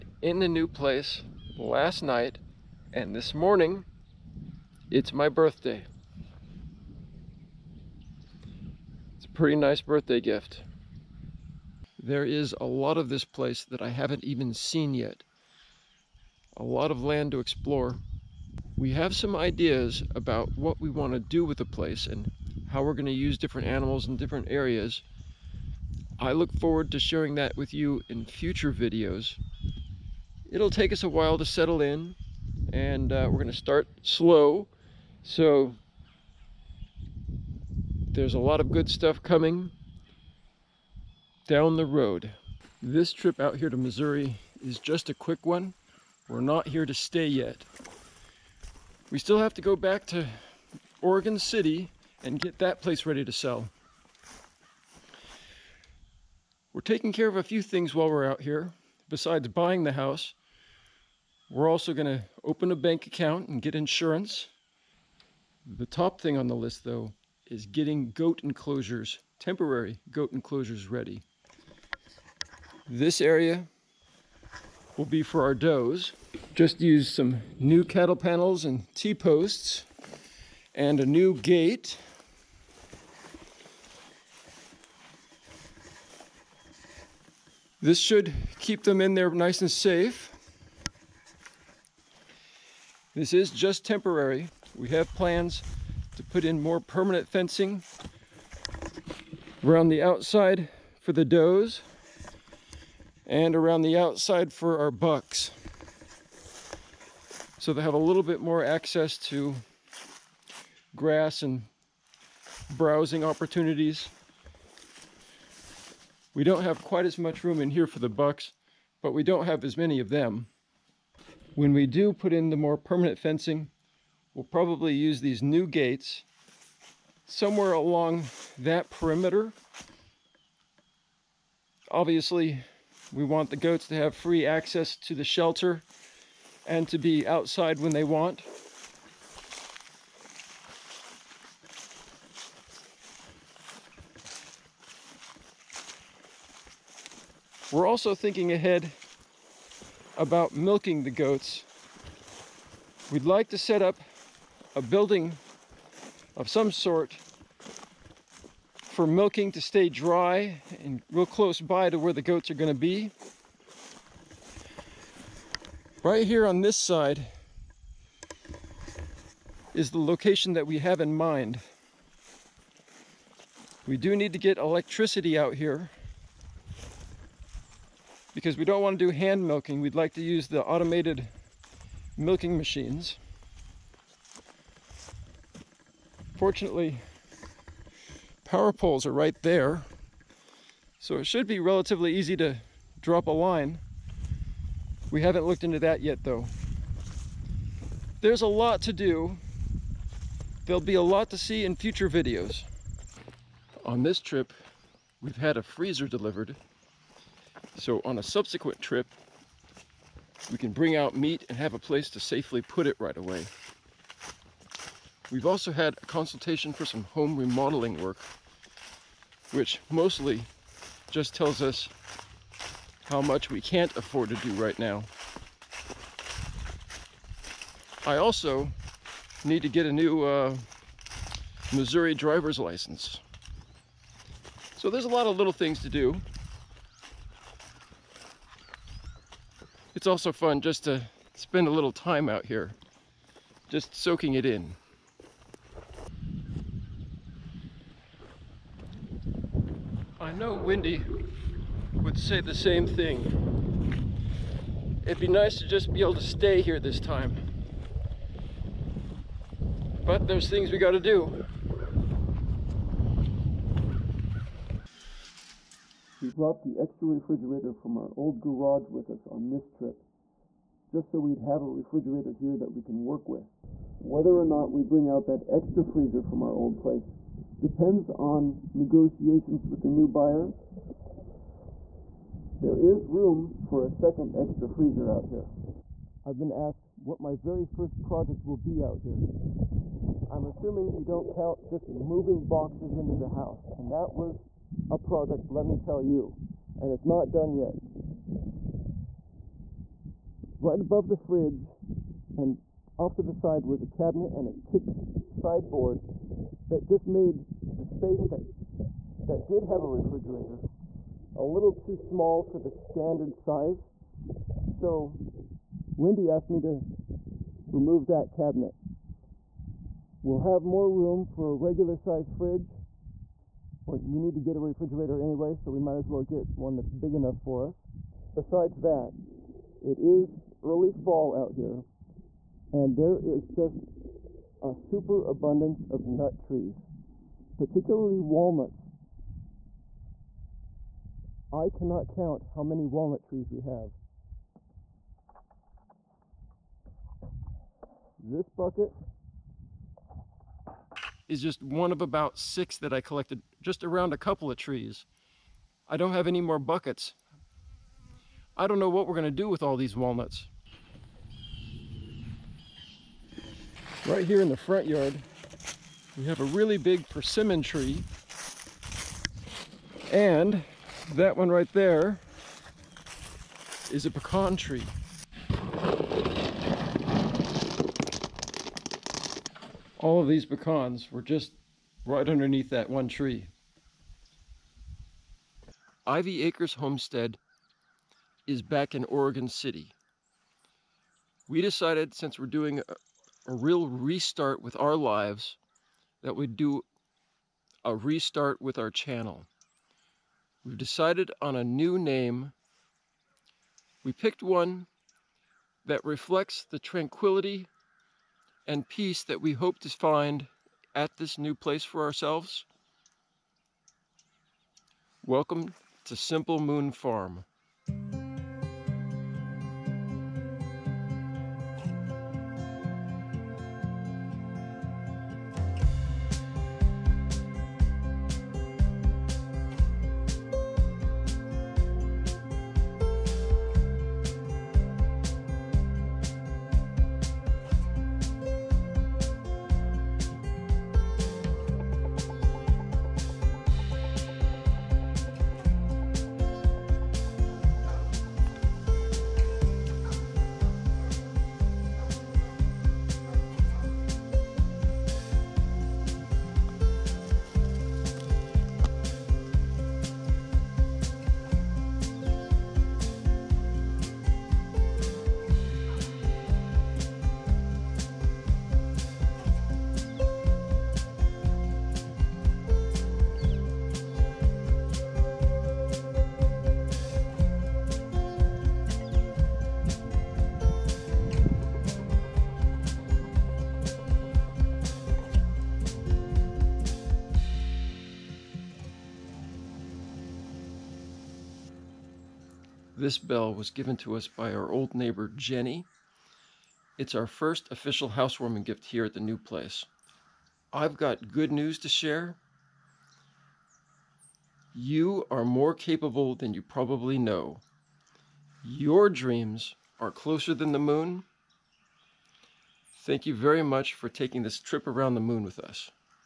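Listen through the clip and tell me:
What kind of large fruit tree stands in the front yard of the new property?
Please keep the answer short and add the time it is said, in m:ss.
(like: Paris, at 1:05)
persimmon, at 6:07.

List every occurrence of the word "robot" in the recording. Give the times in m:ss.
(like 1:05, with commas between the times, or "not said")
not said.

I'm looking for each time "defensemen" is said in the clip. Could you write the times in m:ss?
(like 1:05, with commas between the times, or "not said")
not said.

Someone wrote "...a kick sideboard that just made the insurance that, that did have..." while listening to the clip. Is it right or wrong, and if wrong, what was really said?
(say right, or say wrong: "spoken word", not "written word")
wrong: "space", not "insurance".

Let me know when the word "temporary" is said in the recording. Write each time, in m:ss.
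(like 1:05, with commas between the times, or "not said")
1:09, 1:33.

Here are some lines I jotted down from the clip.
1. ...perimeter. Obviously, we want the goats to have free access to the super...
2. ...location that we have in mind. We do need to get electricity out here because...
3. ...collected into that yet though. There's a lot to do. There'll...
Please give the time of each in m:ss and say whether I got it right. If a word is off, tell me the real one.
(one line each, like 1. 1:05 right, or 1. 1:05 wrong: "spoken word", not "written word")
1. 2:08 wrong: "shelter", not "super"
2. 2:49 right
3. 3:15 wrong: "looked", not "collected".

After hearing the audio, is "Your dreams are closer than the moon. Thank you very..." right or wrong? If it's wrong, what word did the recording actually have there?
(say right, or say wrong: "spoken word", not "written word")
right.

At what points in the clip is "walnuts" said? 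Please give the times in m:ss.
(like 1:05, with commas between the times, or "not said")
5:38, 5:42, 5:59.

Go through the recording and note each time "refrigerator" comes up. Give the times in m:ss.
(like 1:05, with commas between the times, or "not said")
4:27, 4:31, 5:09, 5:24.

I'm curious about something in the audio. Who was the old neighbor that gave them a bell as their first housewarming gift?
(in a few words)
Jenny.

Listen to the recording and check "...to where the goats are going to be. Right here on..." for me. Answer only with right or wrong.
right.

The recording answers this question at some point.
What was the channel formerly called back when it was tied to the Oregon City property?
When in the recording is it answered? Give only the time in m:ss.
6:26.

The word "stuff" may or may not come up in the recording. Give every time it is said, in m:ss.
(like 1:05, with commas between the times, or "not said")
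0:38.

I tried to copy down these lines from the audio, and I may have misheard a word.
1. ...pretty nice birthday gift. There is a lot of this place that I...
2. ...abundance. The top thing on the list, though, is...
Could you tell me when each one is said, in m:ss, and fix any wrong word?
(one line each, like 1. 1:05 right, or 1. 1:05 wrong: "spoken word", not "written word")
1. 0:09 right
2. 1:03 wrong: "insurance", not "abundance".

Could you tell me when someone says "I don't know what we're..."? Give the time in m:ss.
5:58.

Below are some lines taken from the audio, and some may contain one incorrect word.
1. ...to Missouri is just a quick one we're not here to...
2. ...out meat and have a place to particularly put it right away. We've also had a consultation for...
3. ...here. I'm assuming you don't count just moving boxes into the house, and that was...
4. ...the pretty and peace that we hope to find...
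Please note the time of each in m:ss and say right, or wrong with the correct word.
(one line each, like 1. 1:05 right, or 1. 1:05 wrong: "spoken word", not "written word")
1. 0:43 right
2. 3:30 wrong: "safely", not "particularly"
3. 4:48 right
4. 6:46 wrong: "tranquility", not "pretty".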